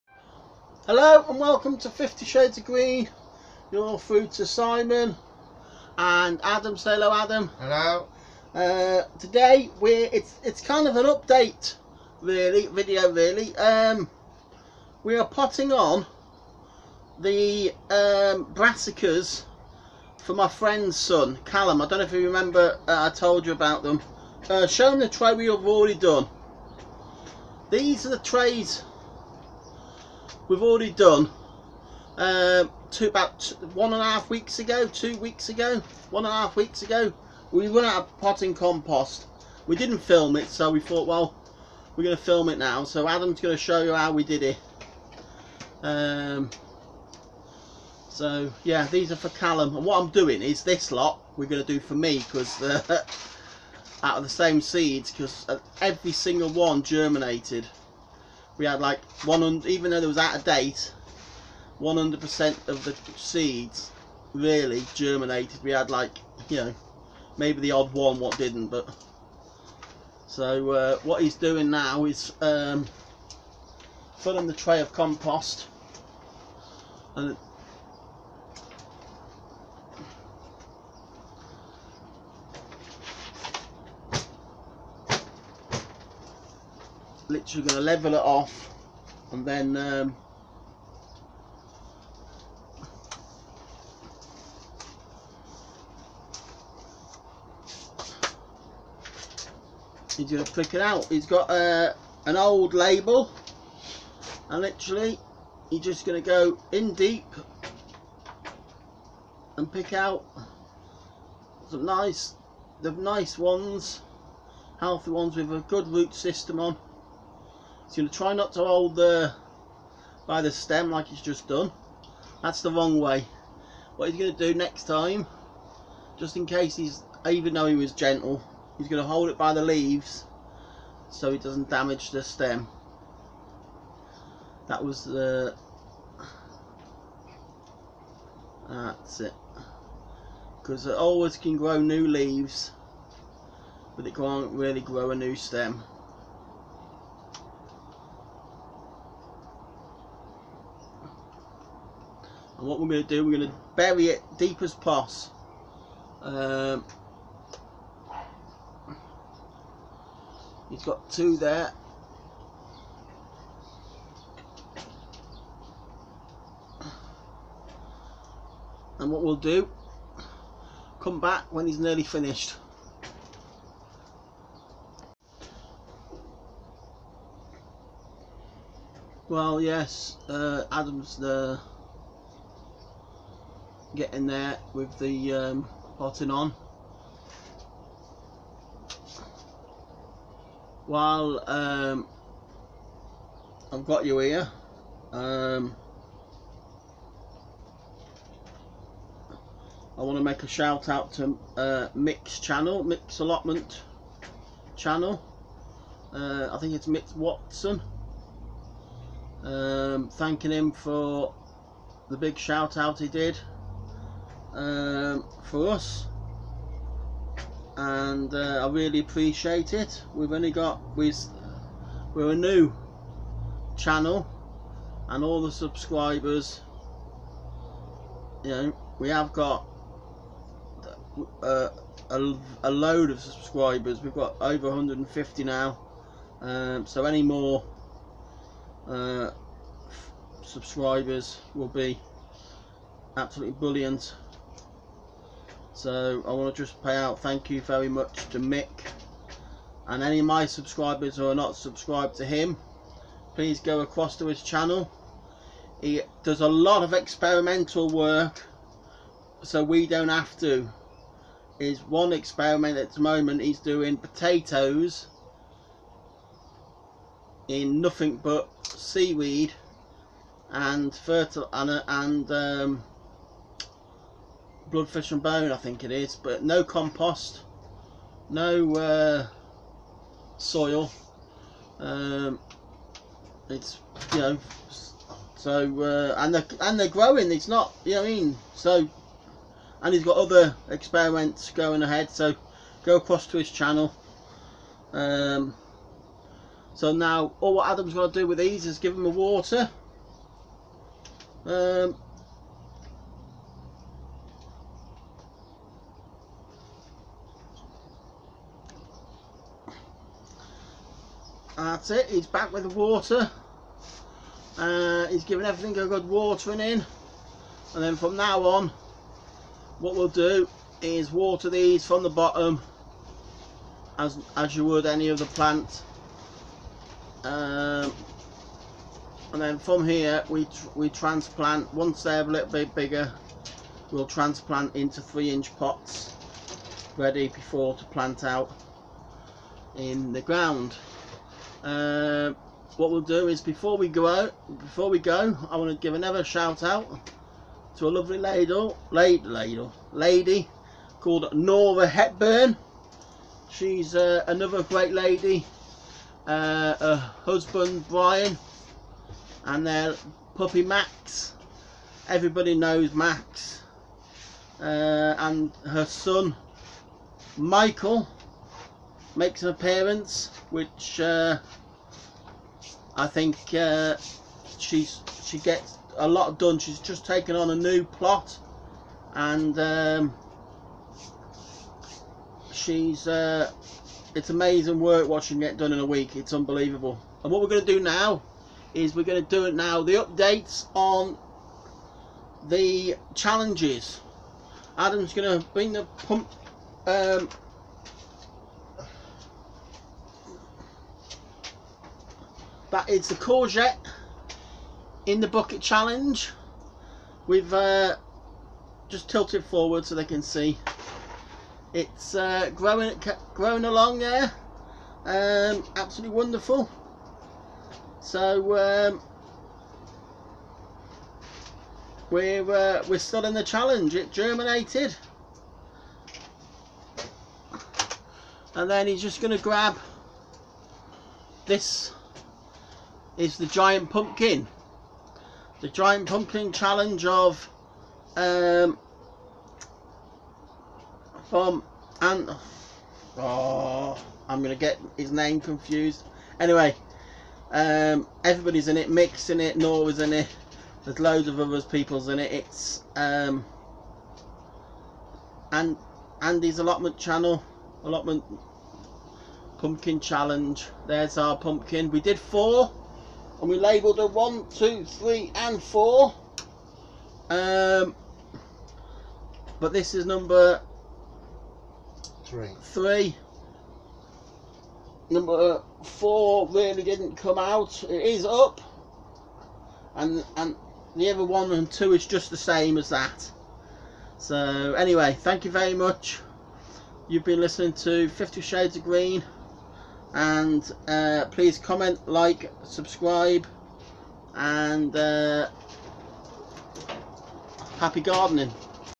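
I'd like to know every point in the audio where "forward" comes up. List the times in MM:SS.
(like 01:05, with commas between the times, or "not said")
06:49.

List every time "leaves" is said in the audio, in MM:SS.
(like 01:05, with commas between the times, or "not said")
02:09, 02:22.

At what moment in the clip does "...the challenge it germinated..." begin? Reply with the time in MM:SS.
07:03.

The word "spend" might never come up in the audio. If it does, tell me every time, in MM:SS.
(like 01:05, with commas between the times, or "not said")
not said.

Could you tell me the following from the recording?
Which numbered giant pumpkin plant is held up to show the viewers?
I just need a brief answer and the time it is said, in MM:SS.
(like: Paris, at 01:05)
3, at 07:50.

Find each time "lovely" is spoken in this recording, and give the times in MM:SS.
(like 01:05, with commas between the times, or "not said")
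05:47.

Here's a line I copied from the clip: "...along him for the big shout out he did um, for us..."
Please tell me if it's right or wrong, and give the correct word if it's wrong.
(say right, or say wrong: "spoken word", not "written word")
wrong: "thanking", not "along".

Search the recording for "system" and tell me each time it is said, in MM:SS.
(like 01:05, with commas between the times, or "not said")
01:56.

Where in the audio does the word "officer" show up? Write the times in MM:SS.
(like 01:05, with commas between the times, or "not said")
not said.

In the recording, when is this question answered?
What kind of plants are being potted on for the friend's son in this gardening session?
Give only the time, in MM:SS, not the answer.
00:18.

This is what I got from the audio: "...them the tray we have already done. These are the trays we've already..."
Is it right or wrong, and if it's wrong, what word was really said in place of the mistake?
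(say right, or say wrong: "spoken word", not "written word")
right.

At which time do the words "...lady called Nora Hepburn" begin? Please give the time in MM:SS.
05:49.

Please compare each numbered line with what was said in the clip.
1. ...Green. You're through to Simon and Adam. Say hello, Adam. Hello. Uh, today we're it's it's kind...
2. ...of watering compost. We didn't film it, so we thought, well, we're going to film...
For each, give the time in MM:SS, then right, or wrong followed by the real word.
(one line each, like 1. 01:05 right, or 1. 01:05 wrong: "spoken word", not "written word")
1. 00:02 right
2. 00:38 wrong: "potting", not "watering".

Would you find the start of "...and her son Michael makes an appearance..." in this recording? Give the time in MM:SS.
06:05.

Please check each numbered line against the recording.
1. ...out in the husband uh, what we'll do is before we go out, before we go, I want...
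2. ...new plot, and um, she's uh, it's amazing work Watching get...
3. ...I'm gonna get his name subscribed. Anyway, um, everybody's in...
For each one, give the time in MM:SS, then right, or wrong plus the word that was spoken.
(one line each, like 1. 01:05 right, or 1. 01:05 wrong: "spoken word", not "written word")
1. 05:38 wrong: "ground", not "husband"
2. 06:17 right
3. 07:24 wrong: "confused", not "subscribed".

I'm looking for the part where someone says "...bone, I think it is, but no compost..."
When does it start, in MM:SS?
04:35.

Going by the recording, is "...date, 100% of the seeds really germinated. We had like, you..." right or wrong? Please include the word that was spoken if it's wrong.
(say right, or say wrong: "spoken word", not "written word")
right.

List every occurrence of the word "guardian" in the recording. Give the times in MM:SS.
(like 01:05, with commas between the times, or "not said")
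not said.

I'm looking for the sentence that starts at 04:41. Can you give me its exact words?
Um, it's you know, so uh, and they and they're growing.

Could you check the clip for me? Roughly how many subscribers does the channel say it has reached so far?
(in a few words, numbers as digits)
over 150.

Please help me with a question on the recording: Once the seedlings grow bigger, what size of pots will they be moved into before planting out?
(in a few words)
3 inch pots.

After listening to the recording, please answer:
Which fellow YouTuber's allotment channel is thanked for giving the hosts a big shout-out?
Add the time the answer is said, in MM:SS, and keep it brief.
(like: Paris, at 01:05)
Mick Watson, at 03:26.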